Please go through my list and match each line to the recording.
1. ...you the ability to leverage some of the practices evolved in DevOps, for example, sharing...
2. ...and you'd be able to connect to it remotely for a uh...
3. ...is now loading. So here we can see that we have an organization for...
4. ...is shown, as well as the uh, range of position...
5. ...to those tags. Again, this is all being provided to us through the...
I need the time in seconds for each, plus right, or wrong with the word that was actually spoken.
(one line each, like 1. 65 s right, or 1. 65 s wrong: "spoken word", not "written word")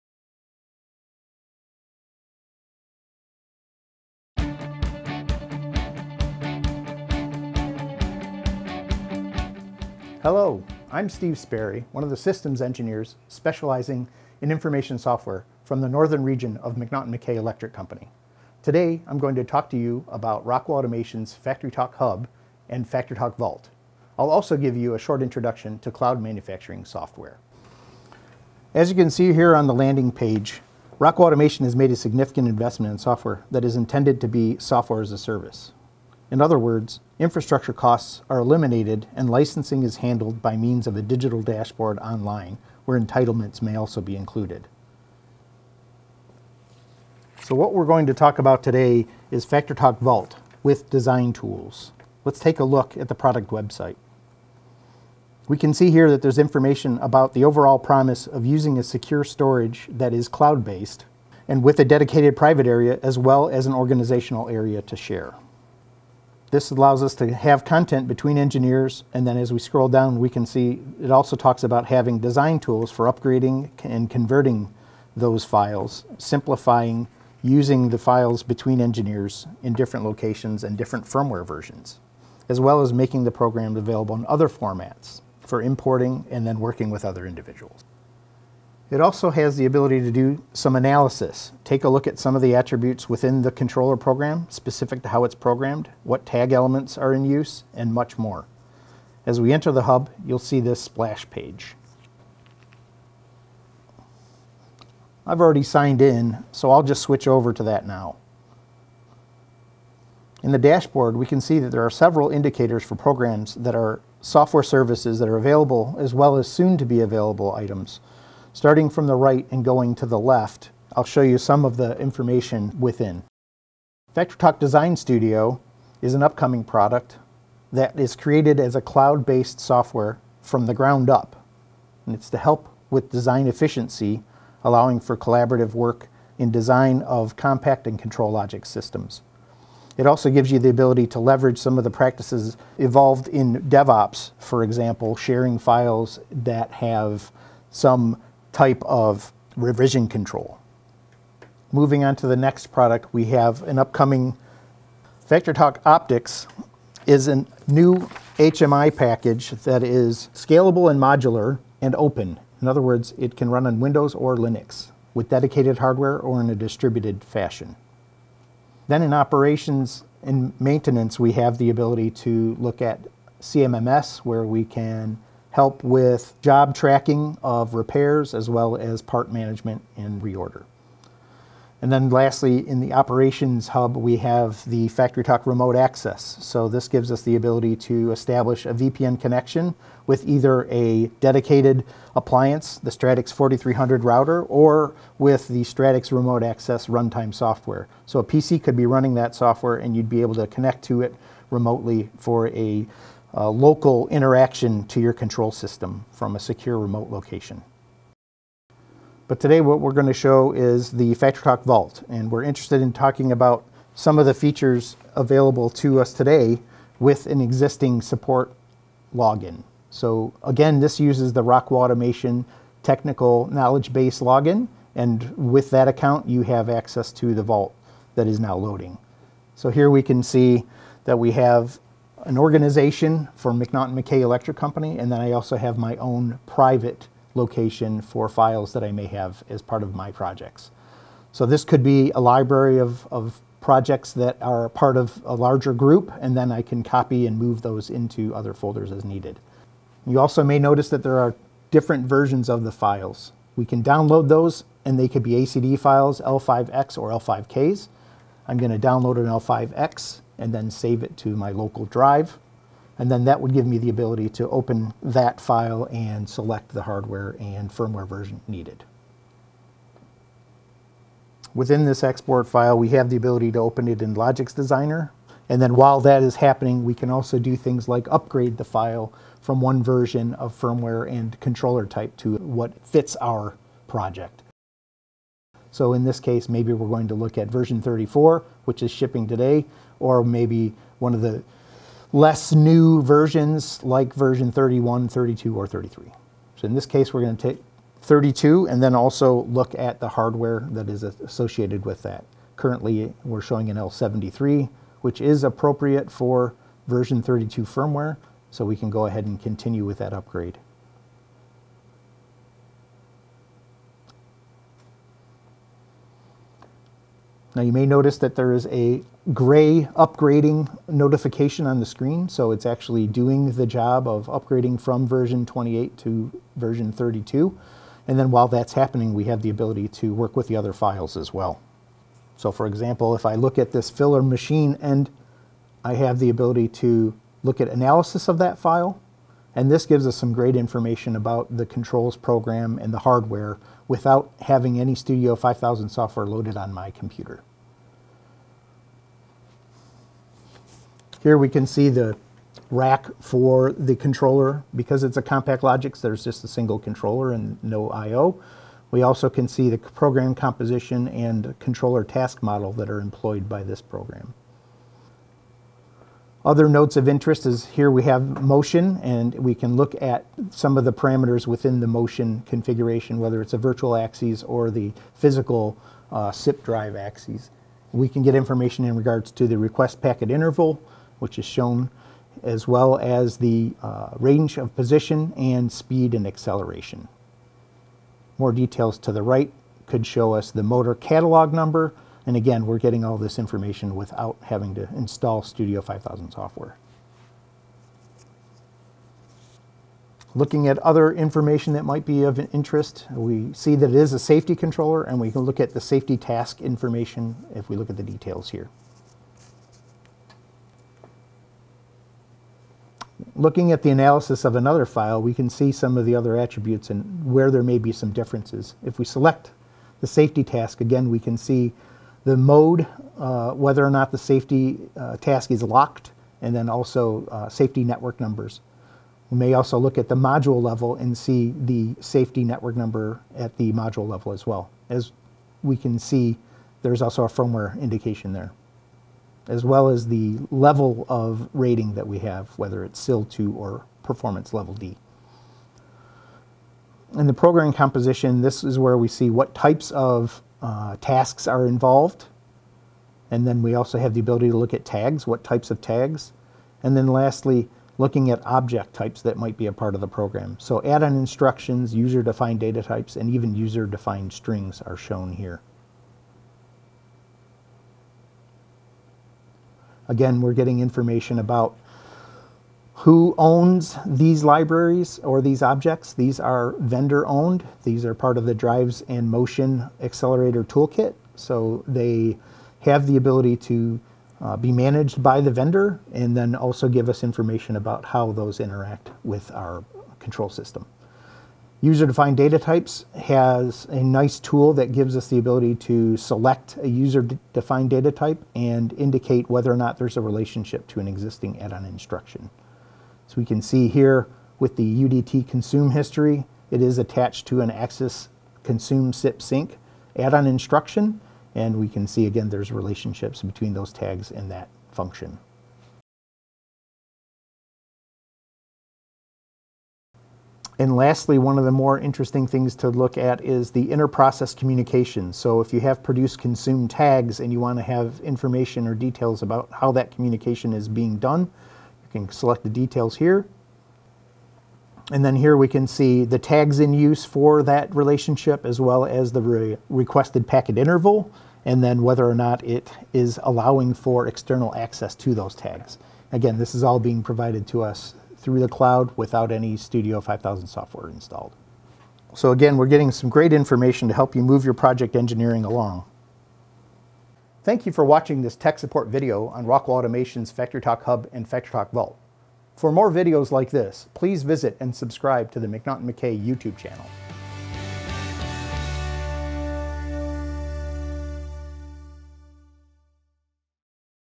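1. 140 s right
2. 199 s right
3. 228 s right
4. 381 s right
5. 545 s right.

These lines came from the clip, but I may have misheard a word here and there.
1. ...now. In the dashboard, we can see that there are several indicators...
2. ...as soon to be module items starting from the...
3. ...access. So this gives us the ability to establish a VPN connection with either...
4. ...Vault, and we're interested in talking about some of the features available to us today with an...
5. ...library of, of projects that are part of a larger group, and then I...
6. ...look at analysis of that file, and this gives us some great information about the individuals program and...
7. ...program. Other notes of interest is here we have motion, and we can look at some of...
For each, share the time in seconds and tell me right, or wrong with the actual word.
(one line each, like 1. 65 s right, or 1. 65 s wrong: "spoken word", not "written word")
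1. 107 s right
2. 116 s wrong: "available", not "module"
3. 185 s right
4. 211 s right
5. 242 s right
6. 337 s wrong: "controls", not "individuals"
7. 363 s right.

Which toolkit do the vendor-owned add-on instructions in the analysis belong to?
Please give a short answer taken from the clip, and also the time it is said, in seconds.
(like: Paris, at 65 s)
Drives and Motion Accelerator Toolkit, at 478 s.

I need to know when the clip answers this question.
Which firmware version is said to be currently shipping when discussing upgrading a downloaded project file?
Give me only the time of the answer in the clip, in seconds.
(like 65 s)
287 s.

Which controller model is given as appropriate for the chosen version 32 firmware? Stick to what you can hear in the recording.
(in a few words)
L73.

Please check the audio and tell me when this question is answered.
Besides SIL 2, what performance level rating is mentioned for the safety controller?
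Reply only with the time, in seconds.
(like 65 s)
444 s.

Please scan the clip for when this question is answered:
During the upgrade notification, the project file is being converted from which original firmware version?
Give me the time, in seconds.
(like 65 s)
325 s.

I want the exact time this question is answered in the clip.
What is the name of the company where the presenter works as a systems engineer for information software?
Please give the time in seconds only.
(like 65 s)
16 s.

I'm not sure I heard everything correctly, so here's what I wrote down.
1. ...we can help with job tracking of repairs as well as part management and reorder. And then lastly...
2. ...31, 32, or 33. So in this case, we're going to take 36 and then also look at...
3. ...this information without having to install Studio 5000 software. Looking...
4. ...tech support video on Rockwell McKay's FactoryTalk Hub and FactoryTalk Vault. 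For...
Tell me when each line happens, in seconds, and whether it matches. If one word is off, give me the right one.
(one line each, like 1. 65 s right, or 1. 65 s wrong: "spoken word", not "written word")
1. 174 s right
2. 294 s wrong: "32", not "36"
3. 393 s right
4. 558 s wrong: "Automation", not "McKay".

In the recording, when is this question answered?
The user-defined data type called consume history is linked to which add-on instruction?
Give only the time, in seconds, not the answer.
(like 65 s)
507 s.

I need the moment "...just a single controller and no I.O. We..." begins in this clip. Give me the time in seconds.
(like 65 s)
356 s.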